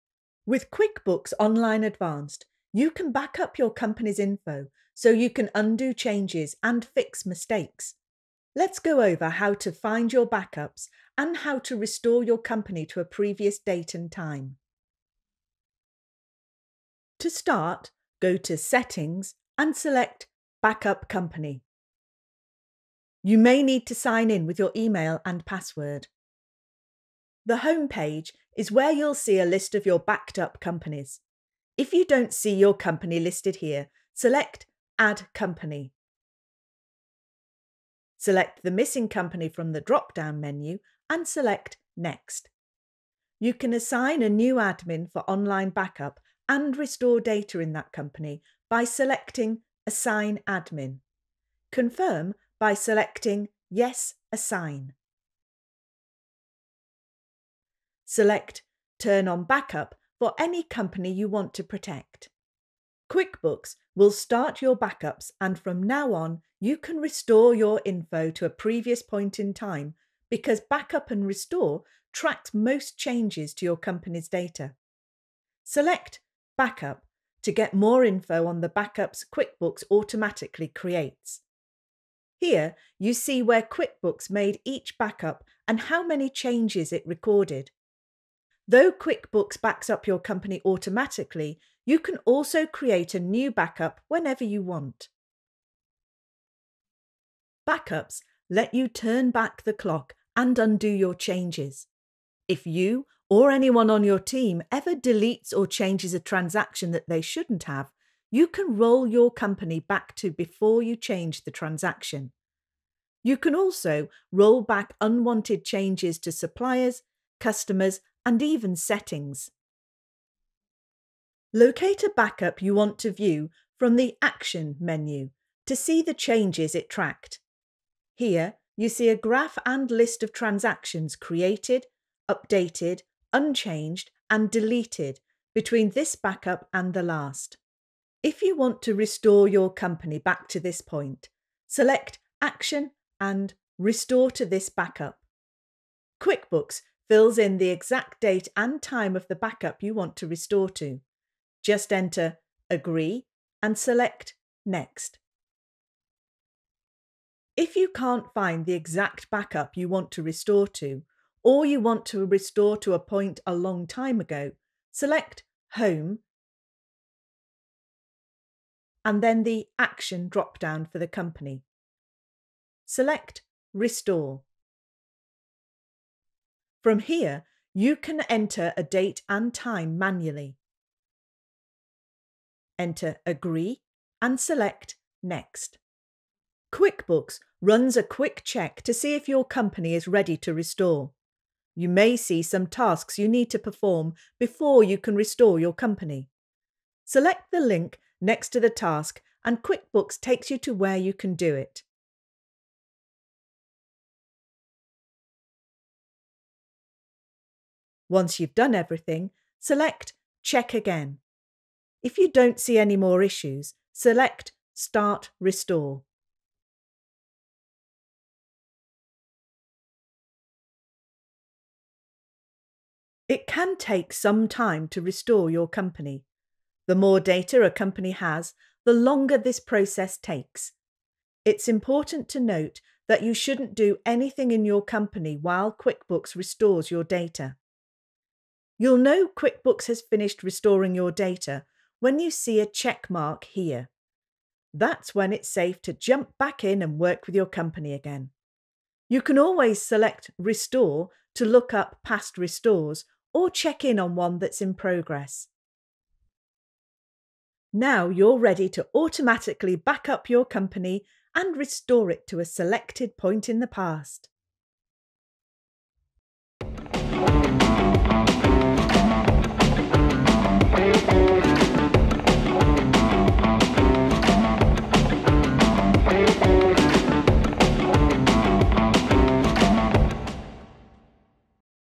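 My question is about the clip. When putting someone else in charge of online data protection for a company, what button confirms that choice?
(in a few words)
Yes, Assign.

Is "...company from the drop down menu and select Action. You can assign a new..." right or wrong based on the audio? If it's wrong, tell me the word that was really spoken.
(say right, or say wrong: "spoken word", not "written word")
wrong: "Next", not "Action".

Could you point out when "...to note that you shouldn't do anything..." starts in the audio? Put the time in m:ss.
3:52.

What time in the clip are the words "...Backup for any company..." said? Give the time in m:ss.
0:59.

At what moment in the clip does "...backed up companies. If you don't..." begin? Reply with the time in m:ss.
0:29.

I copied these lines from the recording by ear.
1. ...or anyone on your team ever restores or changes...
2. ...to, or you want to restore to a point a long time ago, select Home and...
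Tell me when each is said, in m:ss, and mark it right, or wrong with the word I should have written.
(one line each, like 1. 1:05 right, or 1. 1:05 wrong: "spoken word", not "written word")
1. 1:43 wrong: "deletes", not "restores"
2. 2:40 right.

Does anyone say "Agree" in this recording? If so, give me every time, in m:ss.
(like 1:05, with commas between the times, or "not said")
2:32, 3:03.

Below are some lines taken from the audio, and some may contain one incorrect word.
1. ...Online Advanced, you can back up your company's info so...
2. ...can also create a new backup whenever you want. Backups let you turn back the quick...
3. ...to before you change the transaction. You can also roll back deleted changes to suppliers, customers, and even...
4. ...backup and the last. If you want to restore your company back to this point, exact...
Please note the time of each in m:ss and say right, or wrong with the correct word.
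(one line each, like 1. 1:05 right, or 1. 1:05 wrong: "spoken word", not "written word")
1. 0:01 right
2. 1:31 wrong: "clock", not "quick"
3. 1:50 wrong: "unwanted", not "deleted"
4. 2:16 wrong: "select", not "exact".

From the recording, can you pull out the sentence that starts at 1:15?
Select Backup to get more info on the backups QuickBooks automatically creates.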